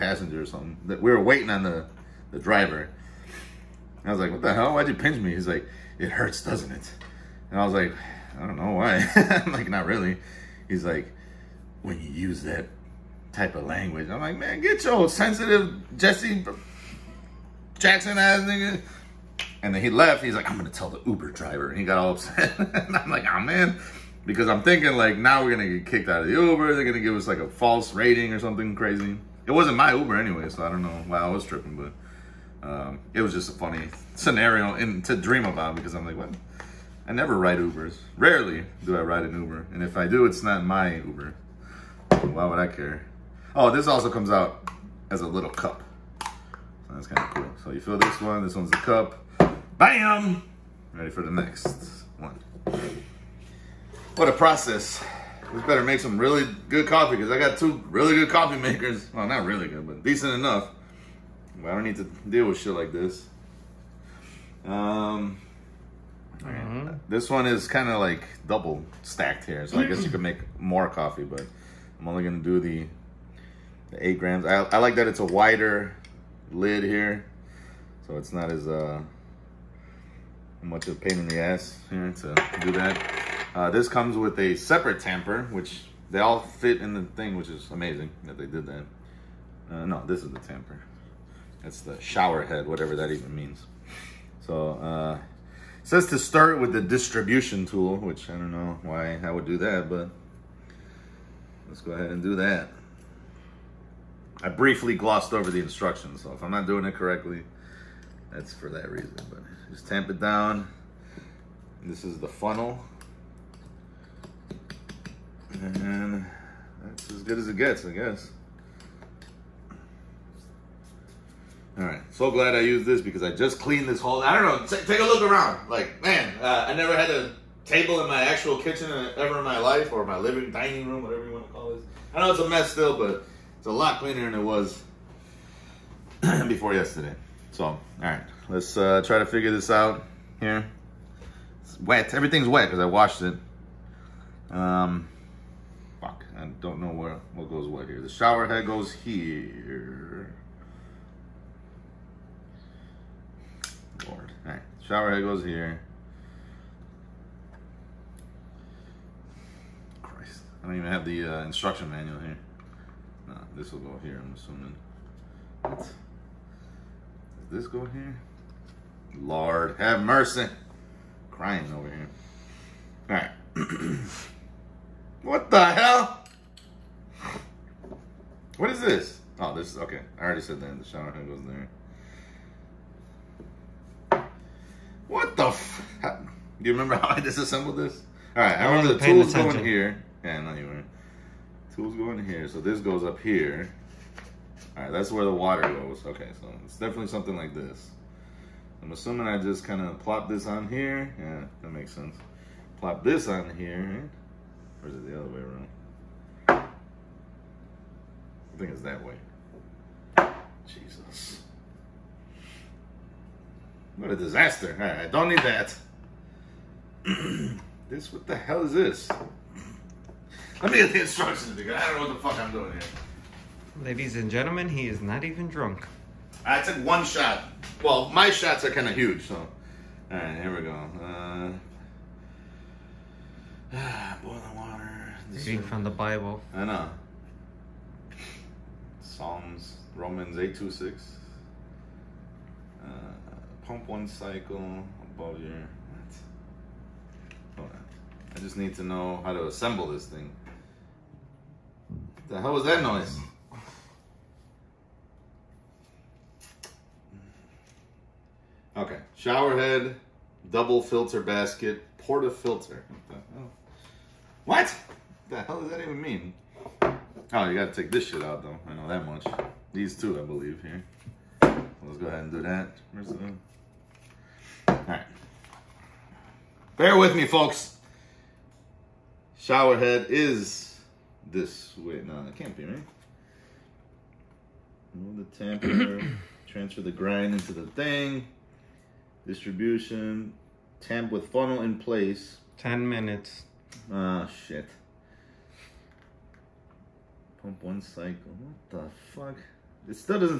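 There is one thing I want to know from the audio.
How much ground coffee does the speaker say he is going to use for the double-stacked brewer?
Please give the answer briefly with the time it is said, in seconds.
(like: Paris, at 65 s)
8 grams, at 74 s.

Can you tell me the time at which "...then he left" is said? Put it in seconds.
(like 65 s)
19 s.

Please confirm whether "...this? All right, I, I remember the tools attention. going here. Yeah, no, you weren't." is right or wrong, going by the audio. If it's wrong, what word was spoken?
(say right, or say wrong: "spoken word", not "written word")
right.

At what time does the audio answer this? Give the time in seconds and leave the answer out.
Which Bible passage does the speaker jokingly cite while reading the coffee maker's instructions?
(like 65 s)
239 s.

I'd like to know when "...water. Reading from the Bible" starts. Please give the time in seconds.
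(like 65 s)
234 s.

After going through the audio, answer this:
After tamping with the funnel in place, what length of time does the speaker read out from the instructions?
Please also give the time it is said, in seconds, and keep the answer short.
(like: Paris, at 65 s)
10 minutes, at 292 s.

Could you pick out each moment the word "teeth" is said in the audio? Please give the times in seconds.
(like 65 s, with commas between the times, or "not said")
not said.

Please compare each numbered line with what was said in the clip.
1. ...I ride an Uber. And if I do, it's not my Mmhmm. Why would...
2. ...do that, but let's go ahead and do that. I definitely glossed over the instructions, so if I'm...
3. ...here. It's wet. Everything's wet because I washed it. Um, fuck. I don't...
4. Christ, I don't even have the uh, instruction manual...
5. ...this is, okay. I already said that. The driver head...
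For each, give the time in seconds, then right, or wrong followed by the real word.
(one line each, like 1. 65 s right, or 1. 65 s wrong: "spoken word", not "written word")
1. 38 s wrong: "Uber", not "Mmhmm"
2. 99 s wrong: "briefly", not "definitely"
3. 140 s right
4. 160 s right
5. 179 s wrong: "shower", not "driver".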